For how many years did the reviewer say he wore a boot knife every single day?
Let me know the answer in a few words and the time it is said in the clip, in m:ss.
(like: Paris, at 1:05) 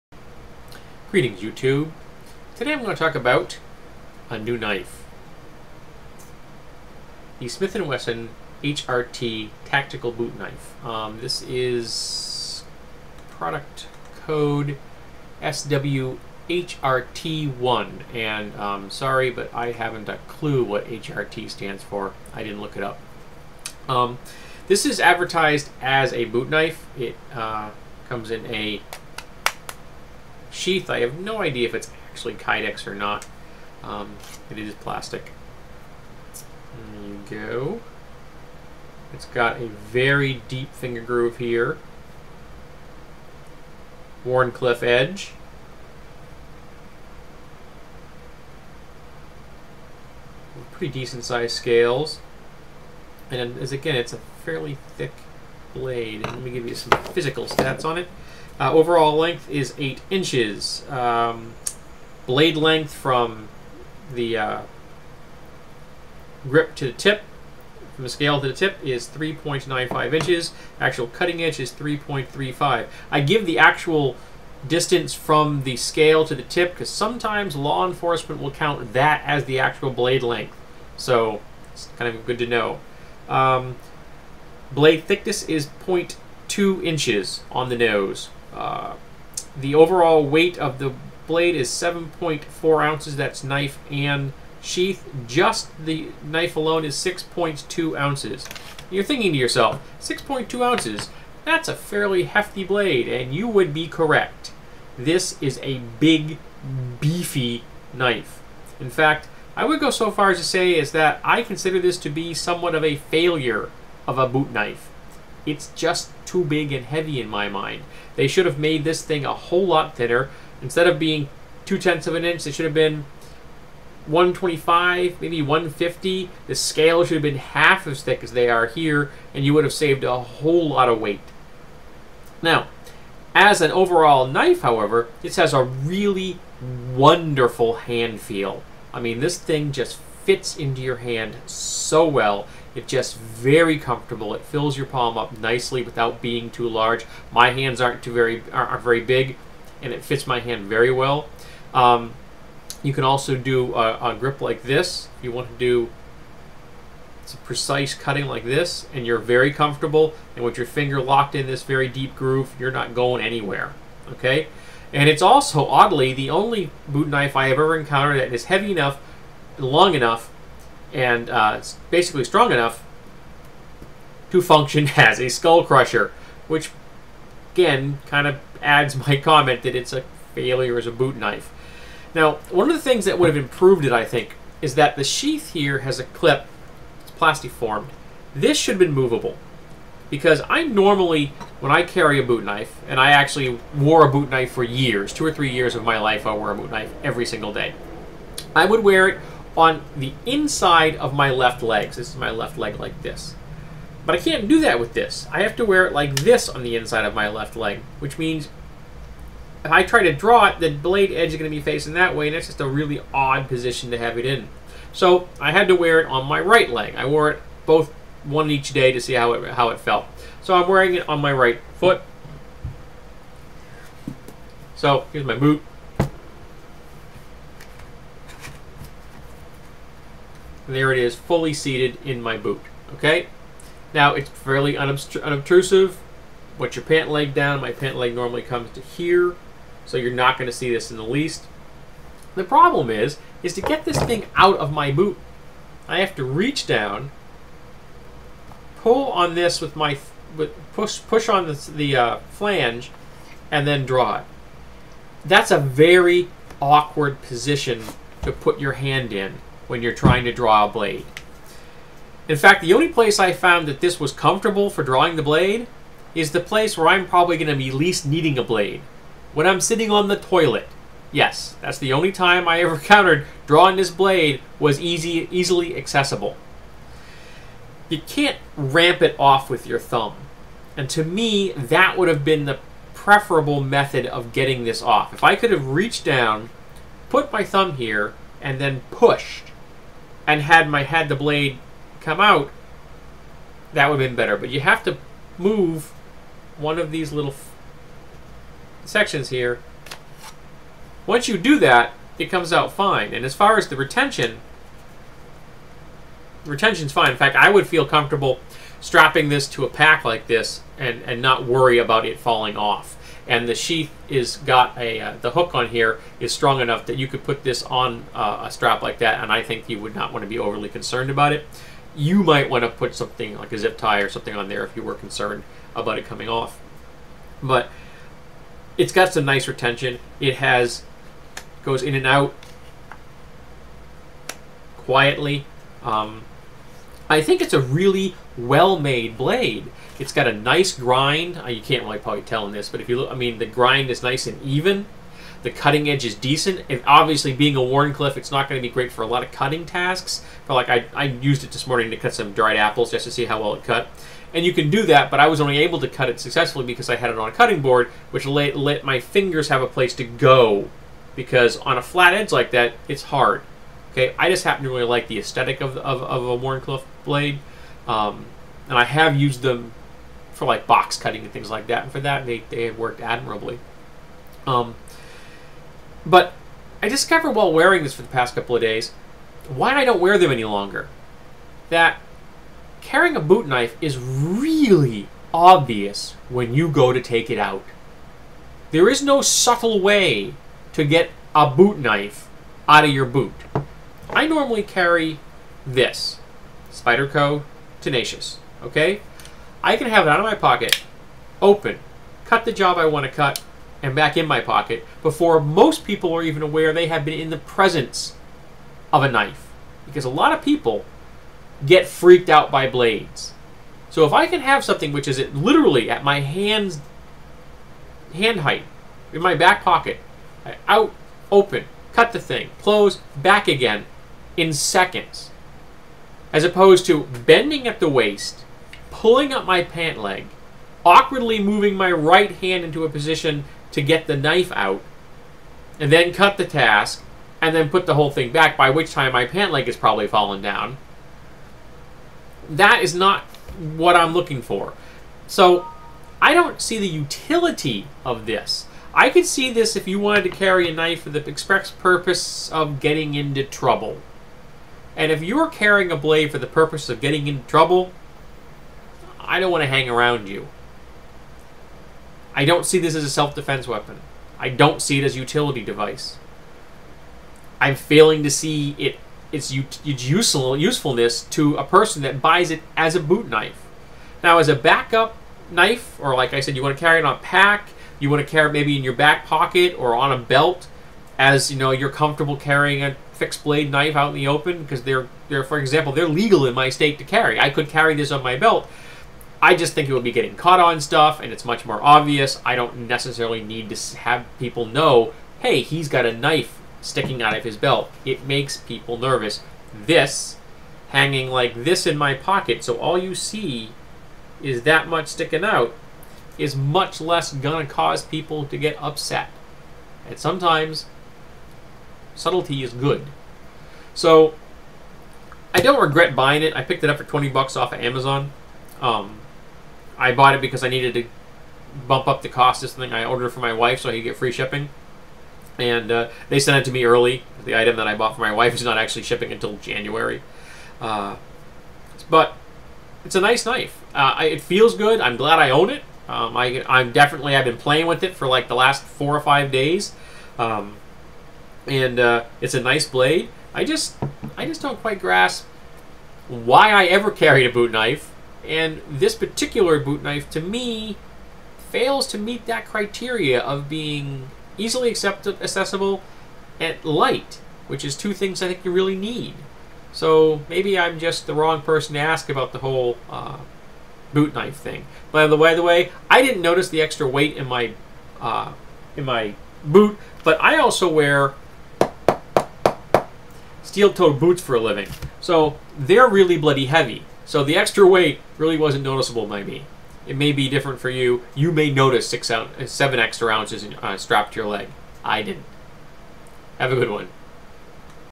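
2 or 3 years, at 3:15.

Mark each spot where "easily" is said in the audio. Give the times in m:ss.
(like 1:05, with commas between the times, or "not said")
4:35, 9:14.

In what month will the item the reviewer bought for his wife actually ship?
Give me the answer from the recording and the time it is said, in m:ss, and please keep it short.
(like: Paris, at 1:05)
January, at 8:49.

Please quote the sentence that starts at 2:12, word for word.
Now, as an overall knife, however, this has a really wonderful hand feel.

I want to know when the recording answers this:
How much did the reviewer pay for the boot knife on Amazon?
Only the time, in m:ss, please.
8:37.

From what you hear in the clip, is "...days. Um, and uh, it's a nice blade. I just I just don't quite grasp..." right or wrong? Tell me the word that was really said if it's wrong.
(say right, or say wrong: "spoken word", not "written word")
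right.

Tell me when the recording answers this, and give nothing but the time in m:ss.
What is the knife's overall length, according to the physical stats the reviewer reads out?
0:59.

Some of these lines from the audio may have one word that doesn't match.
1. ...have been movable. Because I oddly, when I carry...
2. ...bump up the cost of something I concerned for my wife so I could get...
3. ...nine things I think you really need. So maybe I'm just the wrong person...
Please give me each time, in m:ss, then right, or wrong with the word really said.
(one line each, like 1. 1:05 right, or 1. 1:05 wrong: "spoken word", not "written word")
1. 3:08 wrong: "normally", not "oddly"
2. 8:41 wrong: "ordered", not "concerned"
3. 9:17 wrong: "two", not "nine".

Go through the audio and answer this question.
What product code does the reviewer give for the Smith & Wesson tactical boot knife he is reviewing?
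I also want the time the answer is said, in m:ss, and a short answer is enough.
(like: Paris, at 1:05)
SWHRT1, at 0:15.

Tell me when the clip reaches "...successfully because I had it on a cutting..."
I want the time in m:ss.
5:56.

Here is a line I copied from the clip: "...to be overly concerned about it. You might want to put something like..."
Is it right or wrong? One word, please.
right.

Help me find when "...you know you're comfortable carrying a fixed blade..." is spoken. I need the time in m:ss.
8:01.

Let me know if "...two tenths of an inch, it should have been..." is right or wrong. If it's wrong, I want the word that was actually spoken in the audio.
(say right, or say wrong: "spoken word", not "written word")
right.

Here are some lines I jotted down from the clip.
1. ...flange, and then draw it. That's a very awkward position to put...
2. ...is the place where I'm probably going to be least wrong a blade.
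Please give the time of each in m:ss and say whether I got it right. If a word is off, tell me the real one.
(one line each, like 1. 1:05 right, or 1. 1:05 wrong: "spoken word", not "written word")
1. 4:12 right
2. 4:26 wrong: "needing", not "wrong".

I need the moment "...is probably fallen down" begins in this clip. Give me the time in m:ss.
7:19.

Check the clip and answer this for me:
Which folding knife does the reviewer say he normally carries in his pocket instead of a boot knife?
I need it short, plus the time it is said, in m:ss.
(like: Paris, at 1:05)
Spyderco Tenacious, at 6:36.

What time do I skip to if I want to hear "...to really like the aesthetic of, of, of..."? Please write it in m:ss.
6:04.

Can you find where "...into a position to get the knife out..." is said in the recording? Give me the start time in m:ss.
7:12.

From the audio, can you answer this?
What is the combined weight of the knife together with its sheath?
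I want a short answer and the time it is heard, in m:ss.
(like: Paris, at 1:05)
7.4 ounces, at 1:31.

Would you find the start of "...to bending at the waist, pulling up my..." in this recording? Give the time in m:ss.
7:06.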